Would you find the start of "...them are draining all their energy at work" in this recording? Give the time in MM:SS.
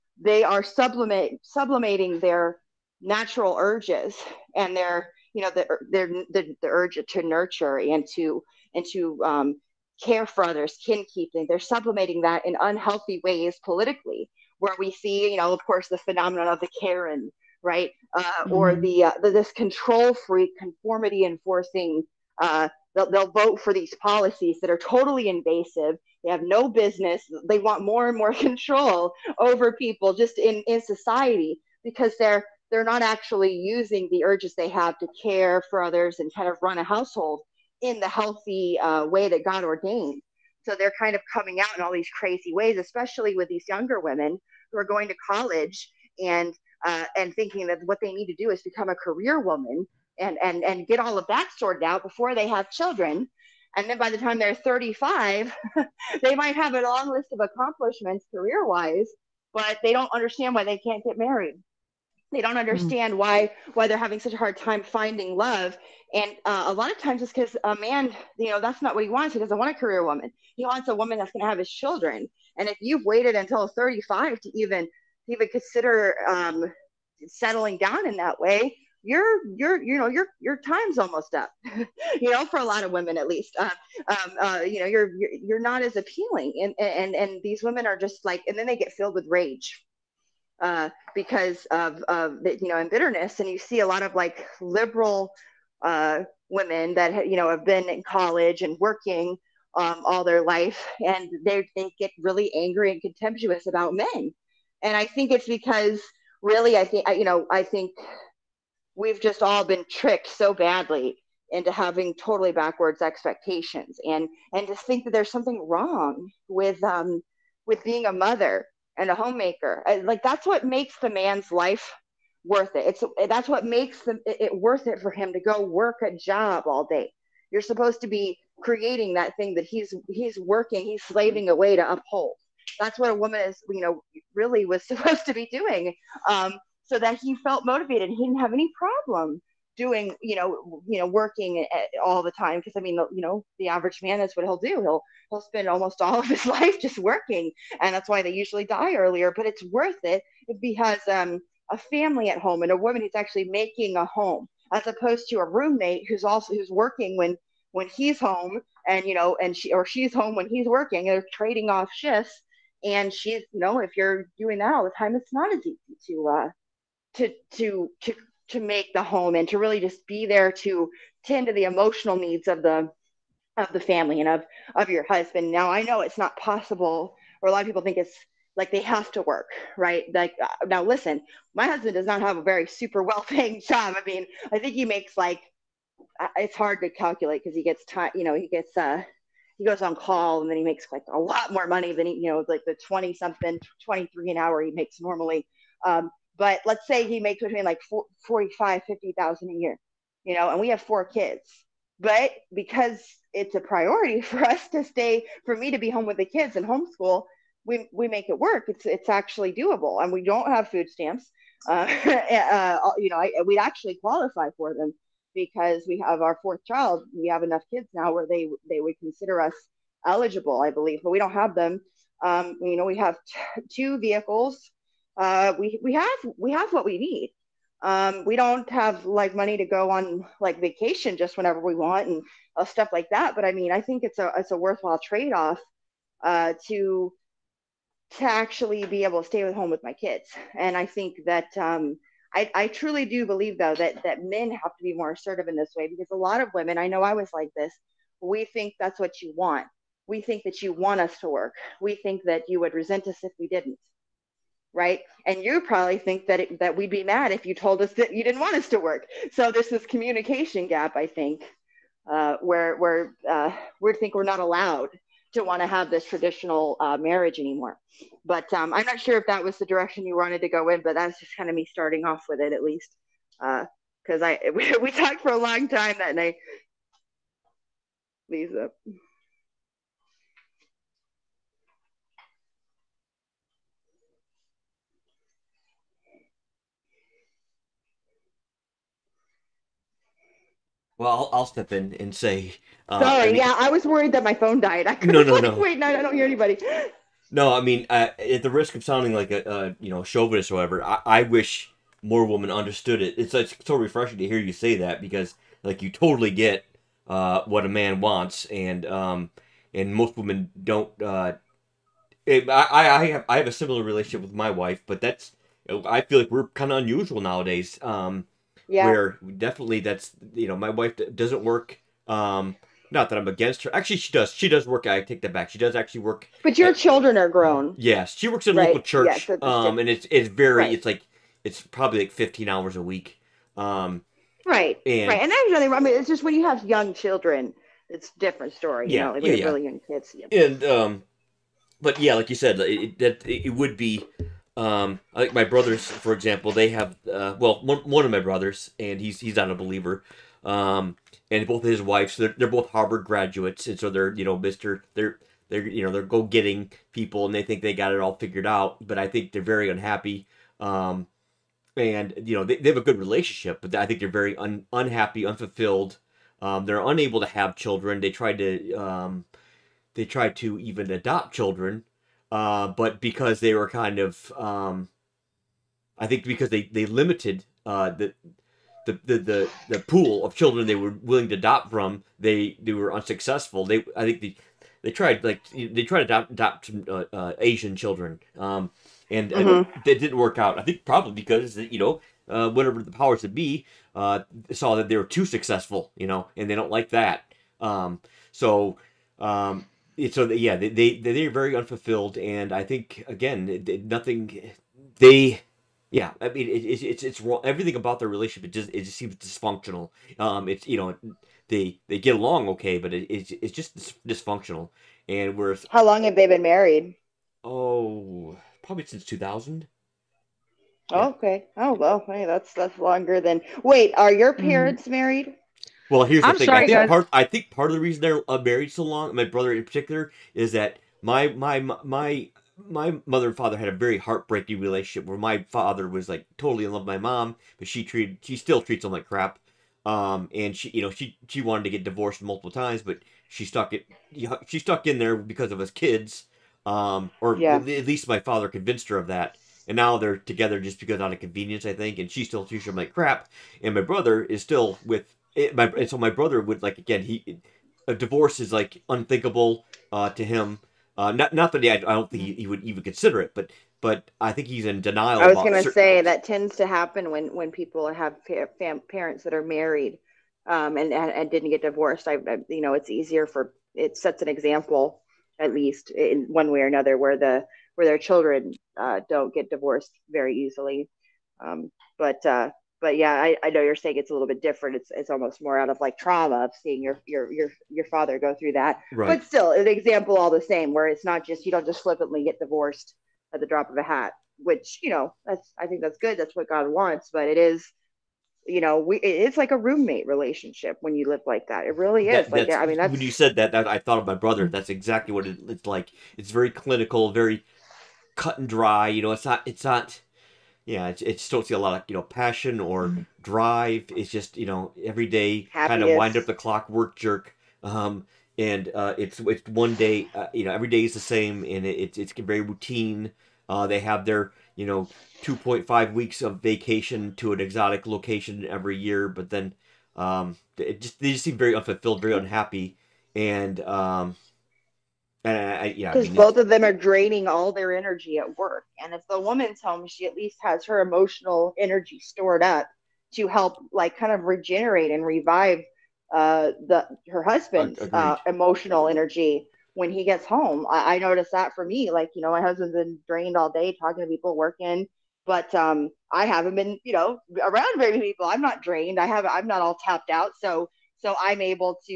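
08:56.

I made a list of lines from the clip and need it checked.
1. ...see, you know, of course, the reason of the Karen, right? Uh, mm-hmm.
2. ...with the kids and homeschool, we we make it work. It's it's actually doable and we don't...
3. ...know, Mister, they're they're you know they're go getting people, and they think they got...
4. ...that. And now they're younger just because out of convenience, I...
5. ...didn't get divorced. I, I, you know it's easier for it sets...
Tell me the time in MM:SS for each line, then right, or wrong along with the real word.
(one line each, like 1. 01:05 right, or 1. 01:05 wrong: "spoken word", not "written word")
1. 00:14 wrong: "phenomenon", not "reason"
2. 03:26 right
3. 05:54 right
4. 07:29 wrong: "together", not "younger"
5. 07:51 right.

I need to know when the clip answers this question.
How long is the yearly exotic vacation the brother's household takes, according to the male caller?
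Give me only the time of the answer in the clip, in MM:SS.
08:45.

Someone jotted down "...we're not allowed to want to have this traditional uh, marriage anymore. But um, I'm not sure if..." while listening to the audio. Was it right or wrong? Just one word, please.
right.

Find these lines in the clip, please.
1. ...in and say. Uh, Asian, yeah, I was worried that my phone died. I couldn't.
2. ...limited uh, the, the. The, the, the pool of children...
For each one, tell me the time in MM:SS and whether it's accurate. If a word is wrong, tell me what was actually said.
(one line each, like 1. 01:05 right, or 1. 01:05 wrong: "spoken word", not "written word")
1. 04:51 wrong: "Sorry", not "Asian"
2. 06:16 right.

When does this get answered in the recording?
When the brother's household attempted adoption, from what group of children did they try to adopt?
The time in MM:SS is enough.
06:27.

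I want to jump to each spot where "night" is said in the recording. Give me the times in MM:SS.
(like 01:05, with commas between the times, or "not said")
04:36.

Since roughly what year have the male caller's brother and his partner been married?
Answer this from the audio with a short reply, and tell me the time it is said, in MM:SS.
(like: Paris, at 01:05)
2000, at 06:59.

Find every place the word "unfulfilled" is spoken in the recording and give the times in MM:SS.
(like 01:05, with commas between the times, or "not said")
06:05, 06:41, 08:51.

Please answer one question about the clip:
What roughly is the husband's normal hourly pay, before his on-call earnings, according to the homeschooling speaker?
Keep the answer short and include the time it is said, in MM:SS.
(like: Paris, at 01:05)
$23 an hour, at 03:13.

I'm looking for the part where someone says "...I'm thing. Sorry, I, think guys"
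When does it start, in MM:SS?
07:06.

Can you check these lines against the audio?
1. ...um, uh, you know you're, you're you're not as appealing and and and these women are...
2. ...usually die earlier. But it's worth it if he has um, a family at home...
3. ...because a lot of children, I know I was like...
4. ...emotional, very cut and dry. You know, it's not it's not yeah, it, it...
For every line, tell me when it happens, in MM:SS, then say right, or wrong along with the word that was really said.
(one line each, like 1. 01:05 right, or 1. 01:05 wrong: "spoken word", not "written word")
1. 01:24 right
2. 02:28 right
3. 04:05 wrong: "women", not "children"
4. 08:26 wrong: "clinical", not "emotional".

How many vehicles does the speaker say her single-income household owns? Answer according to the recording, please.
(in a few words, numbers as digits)
2.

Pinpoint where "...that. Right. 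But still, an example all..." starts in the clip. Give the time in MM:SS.
08:08.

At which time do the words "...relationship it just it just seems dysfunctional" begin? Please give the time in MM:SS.
06:48.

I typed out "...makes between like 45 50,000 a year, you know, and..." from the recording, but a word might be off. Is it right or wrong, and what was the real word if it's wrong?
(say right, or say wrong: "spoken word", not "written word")
right.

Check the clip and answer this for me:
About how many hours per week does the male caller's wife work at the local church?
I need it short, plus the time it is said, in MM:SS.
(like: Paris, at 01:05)
15, at 05:32.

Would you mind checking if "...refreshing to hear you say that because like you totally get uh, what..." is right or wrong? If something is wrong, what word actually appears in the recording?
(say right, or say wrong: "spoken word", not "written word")
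right.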